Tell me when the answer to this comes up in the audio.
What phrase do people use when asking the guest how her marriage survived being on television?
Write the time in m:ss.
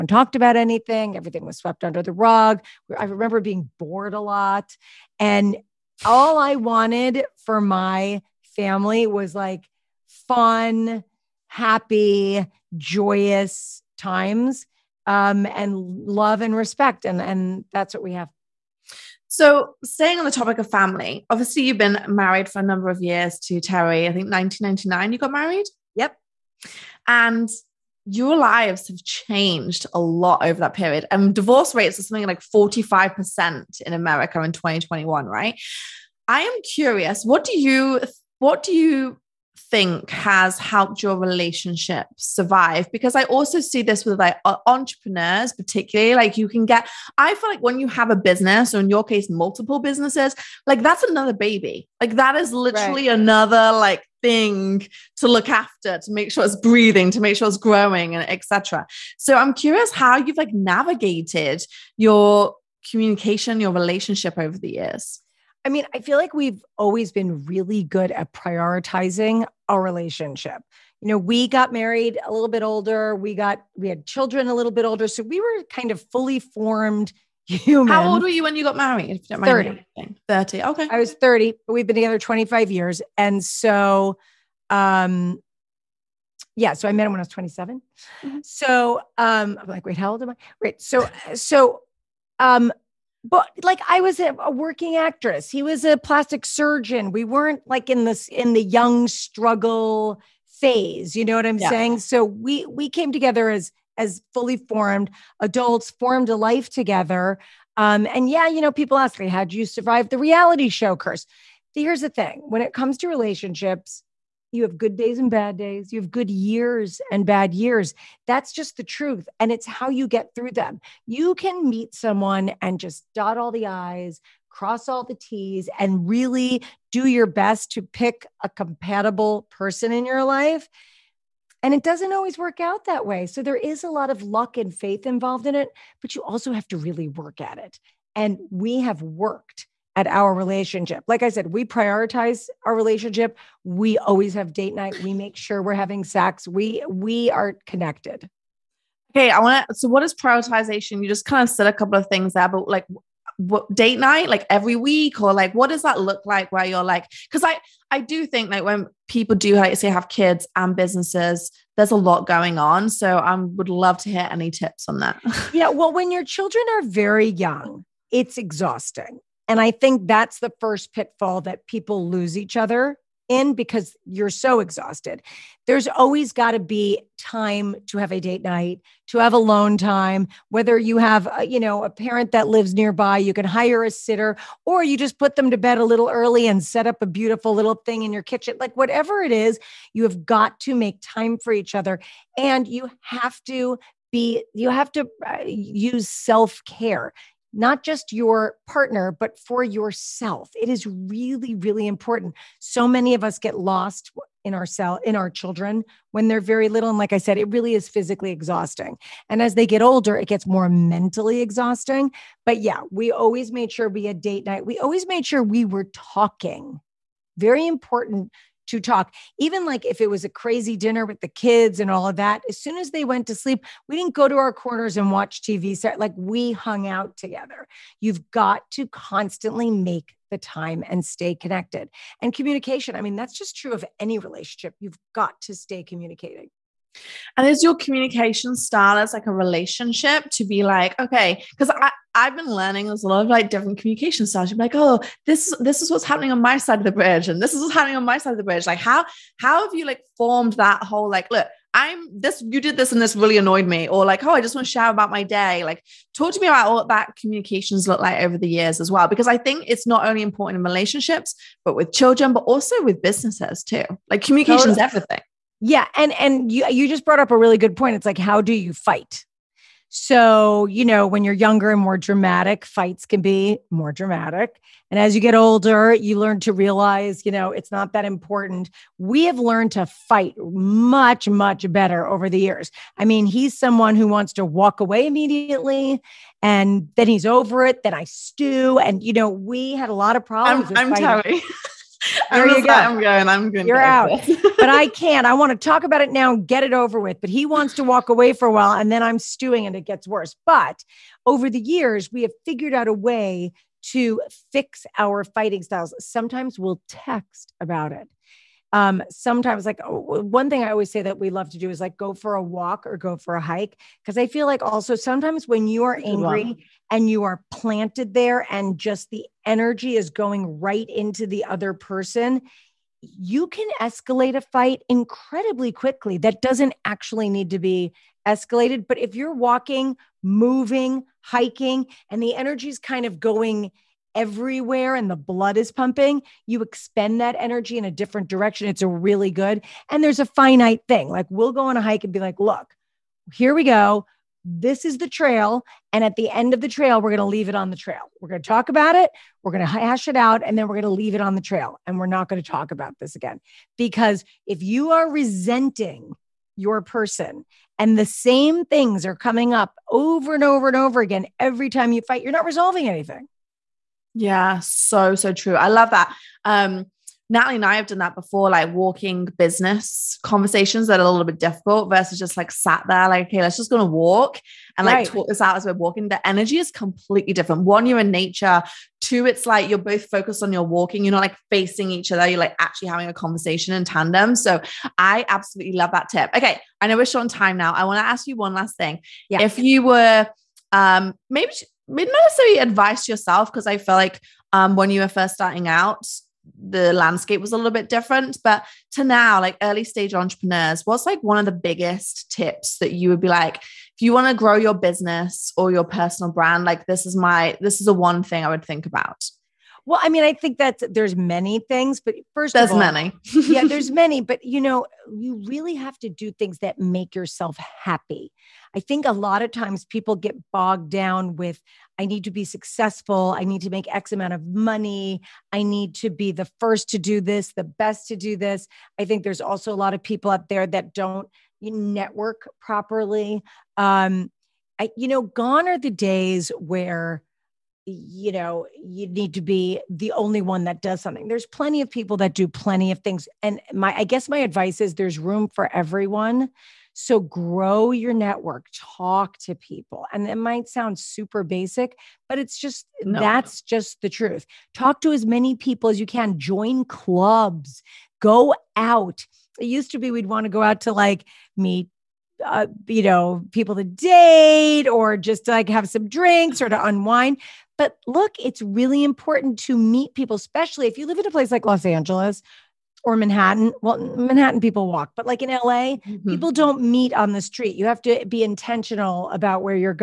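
1:50.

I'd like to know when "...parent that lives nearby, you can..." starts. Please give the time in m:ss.
3:01.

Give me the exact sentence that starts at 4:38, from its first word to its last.
We have learned to fight much, much better over the years.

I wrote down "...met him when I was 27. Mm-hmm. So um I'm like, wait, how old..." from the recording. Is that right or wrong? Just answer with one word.
right.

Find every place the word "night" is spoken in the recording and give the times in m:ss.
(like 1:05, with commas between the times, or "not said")
2:24, 2:33, 2:58, 3:34.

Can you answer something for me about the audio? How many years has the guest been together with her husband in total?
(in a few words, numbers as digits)
25.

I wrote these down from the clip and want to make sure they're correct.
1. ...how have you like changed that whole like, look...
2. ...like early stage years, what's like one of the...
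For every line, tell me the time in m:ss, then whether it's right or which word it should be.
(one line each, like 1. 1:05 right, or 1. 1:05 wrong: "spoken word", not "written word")
1. 4:09 wrong: "formed", not "changed"
2. 6:39 wrong: "entrepreneurs", not "years".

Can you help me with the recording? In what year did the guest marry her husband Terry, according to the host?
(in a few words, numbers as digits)
1999.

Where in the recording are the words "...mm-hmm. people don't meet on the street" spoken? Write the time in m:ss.
7:55.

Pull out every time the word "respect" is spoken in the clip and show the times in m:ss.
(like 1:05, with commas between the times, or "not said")
0:16.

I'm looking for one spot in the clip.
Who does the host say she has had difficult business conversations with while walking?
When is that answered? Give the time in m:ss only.
6:07.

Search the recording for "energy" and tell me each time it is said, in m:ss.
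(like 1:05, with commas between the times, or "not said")
5:19, 5:32, 5:37, 6:16.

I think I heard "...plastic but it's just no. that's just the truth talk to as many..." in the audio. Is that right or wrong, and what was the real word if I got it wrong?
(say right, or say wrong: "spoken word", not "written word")
wrong: "basic", not "plastic".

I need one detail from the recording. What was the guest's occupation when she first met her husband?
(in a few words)
Actress.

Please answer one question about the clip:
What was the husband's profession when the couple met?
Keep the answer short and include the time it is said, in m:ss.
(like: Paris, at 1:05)
Plastic surgeon, at 1:35.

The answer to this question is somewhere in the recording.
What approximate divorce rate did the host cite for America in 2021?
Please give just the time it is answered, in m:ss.
0:32.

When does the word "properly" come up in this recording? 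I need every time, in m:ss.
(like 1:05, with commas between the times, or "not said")
7:12.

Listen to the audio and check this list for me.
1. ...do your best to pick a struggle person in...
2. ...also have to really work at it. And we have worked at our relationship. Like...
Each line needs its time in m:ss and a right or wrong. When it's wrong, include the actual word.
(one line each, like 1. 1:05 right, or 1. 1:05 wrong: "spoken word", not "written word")
1. 2:06 wrong: "compatible", not "struggle"
2. 2:16 right.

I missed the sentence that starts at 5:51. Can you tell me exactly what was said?
And we're not going to talk about this again.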